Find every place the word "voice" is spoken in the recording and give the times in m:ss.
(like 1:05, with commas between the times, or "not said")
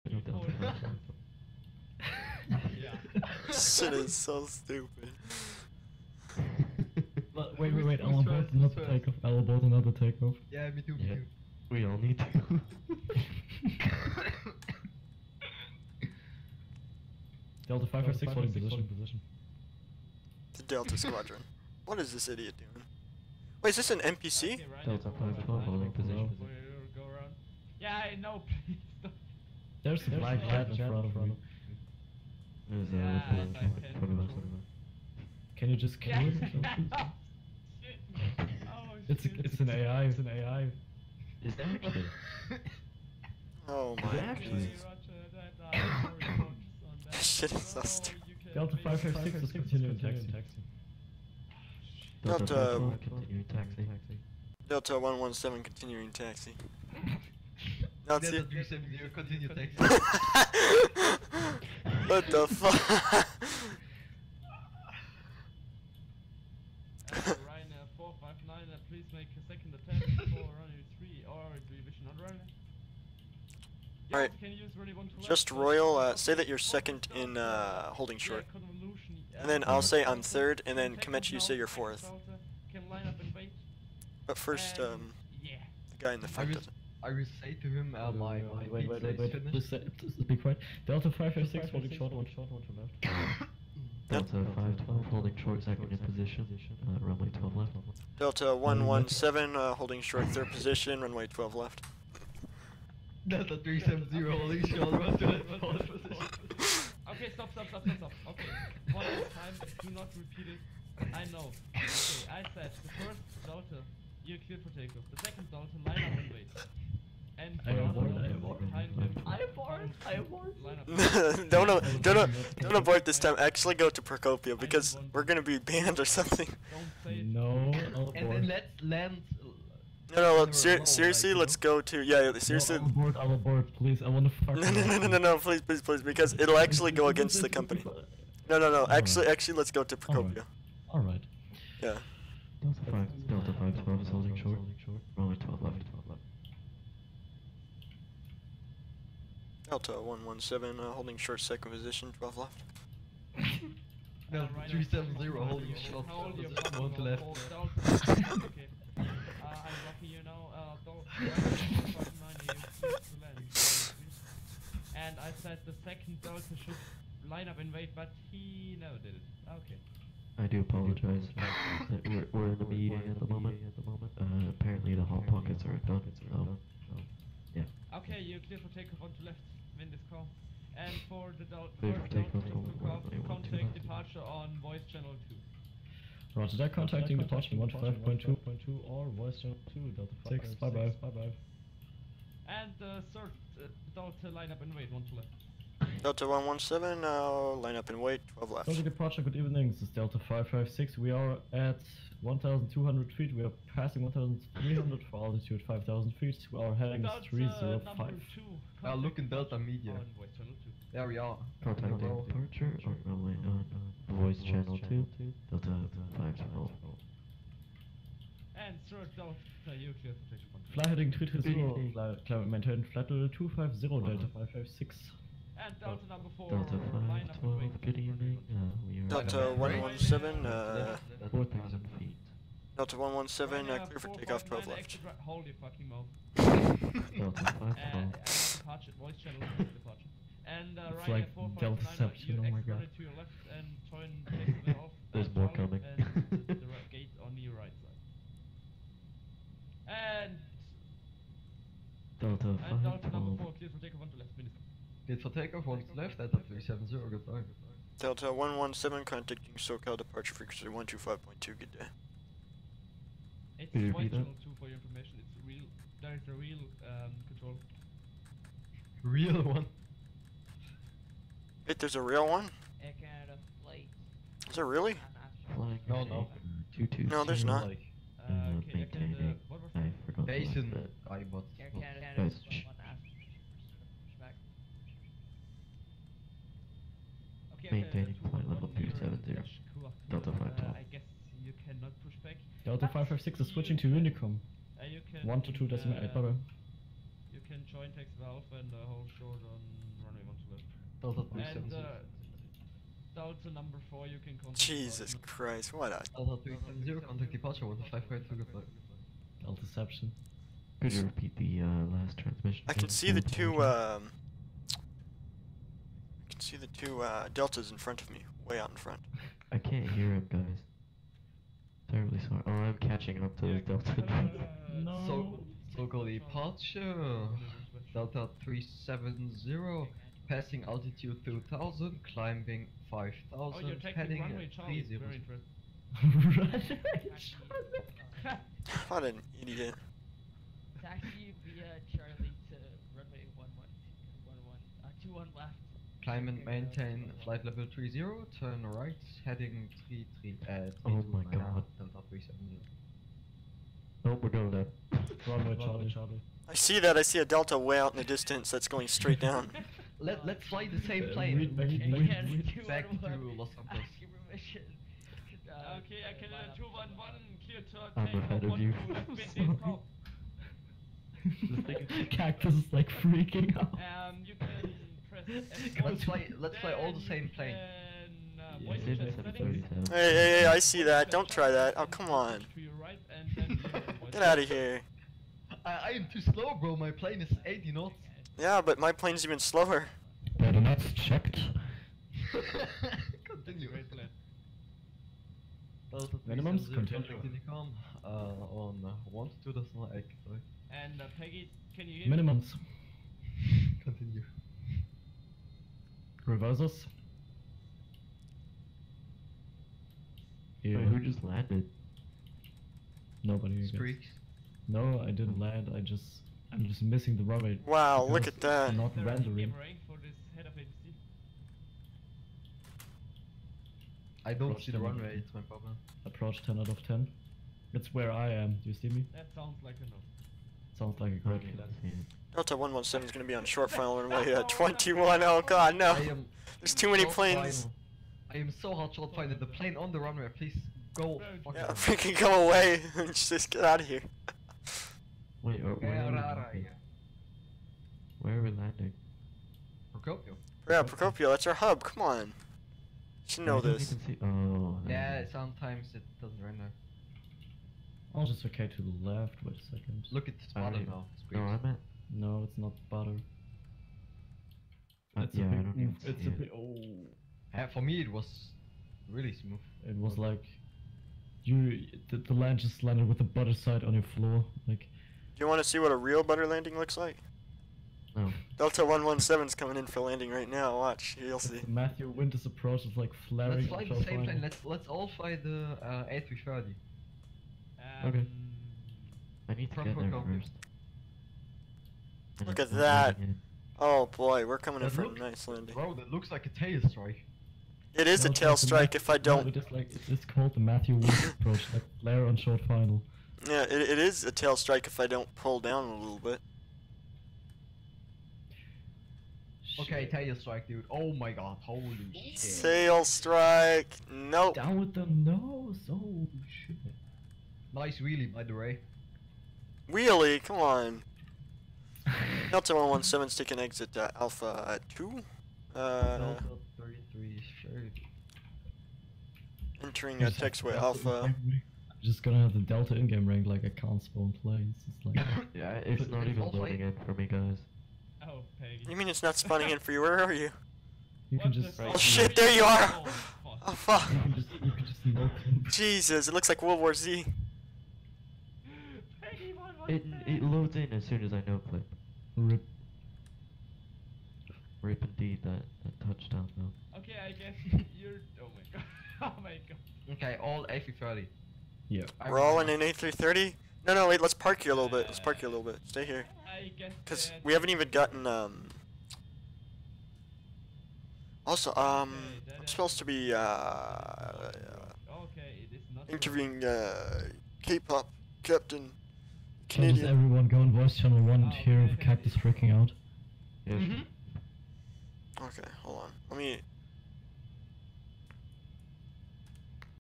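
3:04, 3:09, 3:34, 3:58, 9:40.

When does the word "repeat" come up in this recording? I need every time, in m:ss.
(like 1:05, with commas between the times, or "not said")
1:50, 5:11.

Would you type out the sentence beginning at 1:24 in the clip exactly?
But first, um, the guy in the front doesn't.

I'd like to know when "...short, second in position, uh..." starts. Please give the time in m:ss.
1:35.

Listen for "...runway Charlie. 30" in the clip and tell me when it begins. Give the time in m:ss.
5:34.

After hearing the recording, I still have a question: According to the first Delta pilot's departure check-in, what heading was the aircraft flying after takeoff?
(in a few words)
305.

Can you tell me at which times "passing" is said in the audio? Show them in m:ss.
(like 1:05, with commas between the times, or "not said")
3:23, 5:30.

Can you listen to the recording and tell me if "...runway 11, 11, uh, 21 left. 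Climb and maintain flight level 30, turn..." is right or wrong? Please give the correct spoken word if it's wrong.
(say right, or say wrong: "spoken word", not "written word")
right.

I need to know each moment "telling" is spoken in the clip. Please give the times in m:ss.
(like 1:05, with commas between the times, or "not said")
not said.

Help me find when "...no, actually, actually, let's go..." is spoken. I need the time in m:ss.
2:18.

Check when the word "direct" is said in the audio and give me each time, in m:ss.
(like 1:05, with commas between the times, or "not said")
4:26.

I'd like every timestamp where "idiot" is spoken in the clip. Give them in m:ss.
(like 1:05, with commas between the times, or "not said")
0:22, 5:39.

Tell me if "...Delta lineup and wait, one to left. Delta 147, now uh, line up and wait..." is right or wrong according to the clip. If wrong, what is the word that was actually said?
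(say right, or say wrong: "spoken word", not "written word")
wrong: "117", not "147".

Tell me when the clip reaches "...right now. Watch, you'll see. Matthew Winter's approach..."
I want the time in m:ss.
8:00.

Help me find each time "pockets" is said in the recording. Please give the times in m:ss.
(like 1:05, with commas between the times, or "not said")
2:55.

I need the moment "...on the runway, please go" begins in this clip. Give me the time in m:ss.
7:19.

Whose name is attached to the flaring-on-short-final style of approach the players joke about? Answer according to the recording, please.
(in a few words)
Matthew Woods.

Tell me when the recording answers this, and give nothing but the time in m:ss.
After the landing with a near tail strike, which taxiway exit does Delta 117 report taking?
8:44.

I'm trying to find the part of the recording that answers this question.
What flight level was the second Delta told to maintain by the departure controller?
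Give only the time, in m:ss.
3:42.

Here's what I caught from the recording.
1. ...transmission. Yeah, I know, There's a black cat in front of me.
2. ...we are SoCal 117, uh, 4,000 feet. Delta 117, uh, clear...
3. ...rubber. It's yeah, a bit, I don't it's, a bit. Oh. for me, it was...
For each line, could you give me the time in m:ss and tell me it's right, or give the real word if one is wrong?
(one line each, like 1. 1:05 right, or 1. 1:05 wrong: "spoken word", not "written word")
1. 0:25 wrong: "position", not "transmission"
2. 3:48 wrong: "Delta", not "SoCal"
3. 7:42 wrong: "butter", not "rubber".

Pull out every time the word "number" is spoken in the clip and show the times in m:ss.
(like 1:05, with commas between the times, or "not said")
3:46, 5:03.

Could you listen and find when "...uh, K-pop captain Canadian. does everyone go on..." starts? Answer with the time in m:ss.
9:36.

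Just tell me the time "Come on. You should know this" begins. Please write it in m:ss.
7:31.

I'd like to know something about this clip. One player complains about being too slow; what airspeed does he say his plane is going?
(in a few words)
80 knots.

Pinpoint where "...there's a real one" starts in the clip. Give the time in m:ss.
4:31.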